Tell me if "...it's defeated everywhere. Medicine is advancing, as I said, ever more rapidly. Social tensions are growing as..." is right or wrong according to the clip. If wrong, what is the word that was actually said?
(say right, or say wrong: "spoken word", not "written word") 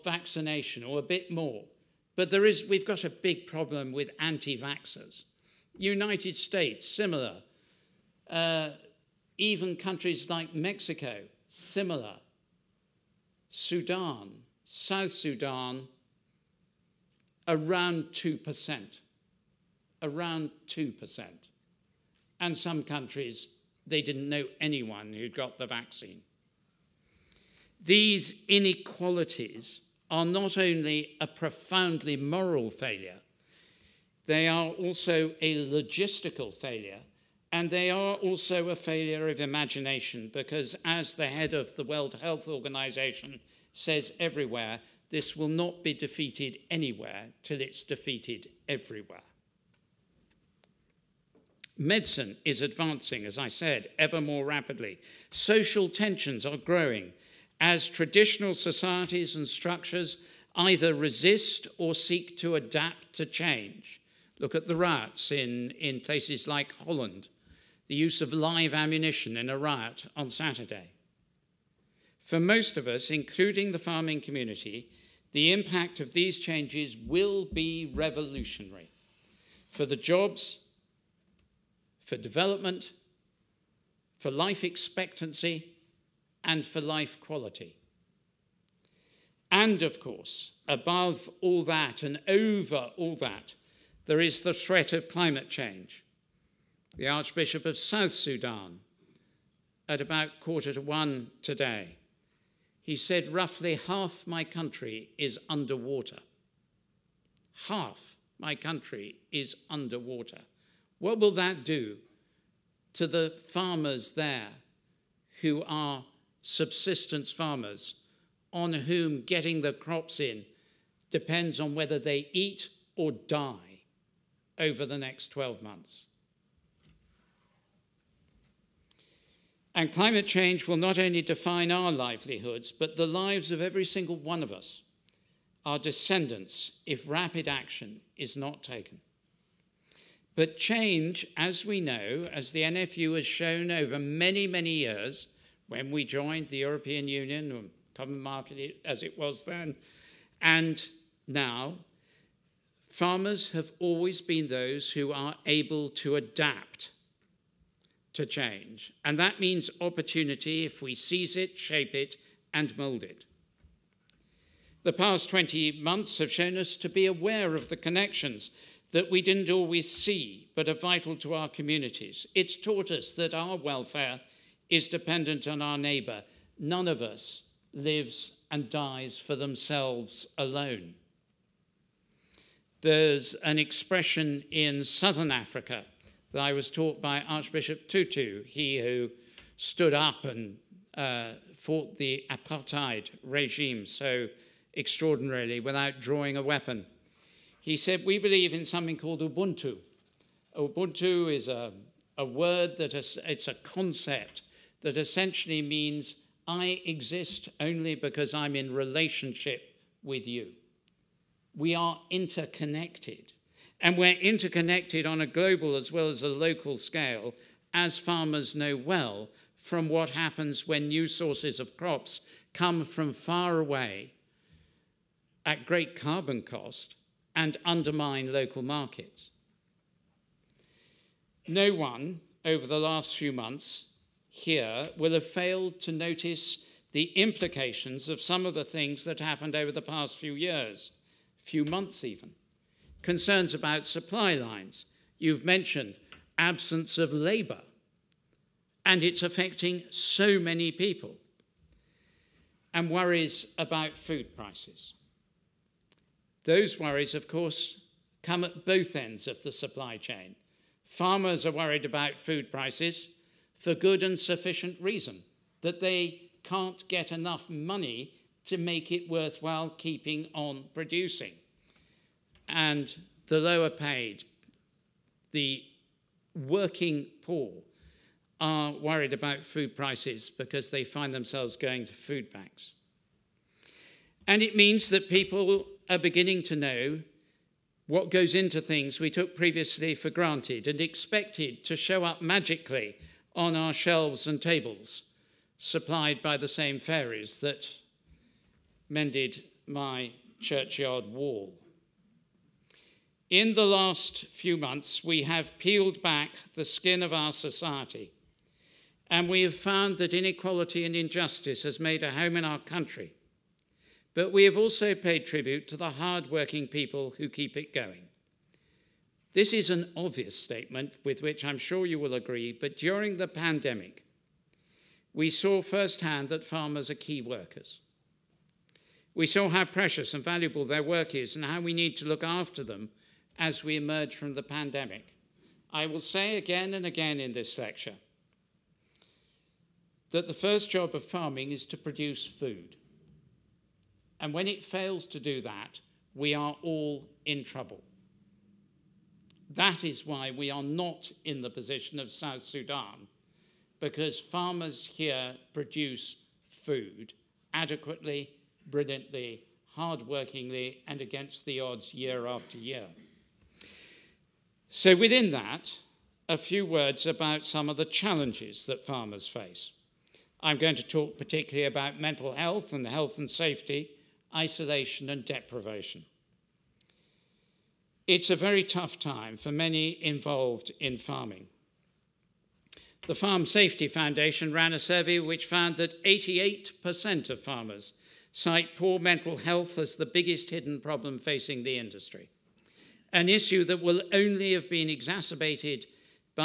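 right.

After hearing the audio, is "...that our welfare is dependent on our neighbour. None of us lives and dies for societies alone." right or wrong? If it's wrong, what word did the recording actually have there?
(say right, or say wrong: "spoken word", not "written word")
wrong: "themselves", not "societies".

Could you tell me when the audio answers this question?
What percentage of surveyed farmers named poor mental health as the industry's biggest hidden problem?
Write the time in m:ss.
6:26.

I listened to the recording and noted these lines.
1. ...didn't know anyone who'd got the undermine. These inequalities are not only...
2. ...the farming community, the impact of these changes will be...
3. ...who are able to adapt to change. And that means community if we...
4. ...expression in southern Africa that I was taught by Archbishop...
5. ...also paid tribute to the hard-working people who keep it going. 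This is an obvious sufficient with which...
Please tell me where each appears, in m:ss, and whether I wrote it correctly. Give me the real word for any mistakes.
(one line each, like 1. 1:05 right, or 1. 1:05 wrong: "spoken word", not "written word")
1. 0:24 wrong: "vaccine", not "undermine"
2. 1:13 right
3. 2:34 wrong: "opportunity", not "community"
4. 3:03 right
5. 5:14 wrong: "statement", not "sufficient".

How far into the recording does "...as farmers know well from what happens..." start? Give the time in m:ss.
3:37.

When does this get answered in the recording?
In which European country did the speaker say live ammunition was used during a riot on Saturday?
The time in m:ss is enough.
1:06.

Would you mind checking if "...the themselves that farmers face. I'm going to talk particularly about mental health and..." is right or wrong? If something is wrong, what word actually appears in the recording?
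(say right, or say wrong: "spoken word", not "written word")
wrong: "challenges", not "themselves".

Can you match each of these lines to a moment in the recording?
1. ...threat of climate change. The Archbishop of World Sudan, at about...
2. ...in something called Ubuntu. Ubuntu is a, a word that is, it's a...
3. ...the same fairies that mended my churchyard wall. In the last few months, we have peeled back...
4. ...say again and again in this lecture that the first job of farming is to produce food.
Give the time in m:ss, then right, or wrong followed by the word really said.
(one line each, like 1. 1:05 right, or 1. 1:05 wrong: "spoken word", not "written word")
1. 1:34 wrong: "South", not "World"
2. 3:18 right
3. 4:56 right
4. 5:35 right.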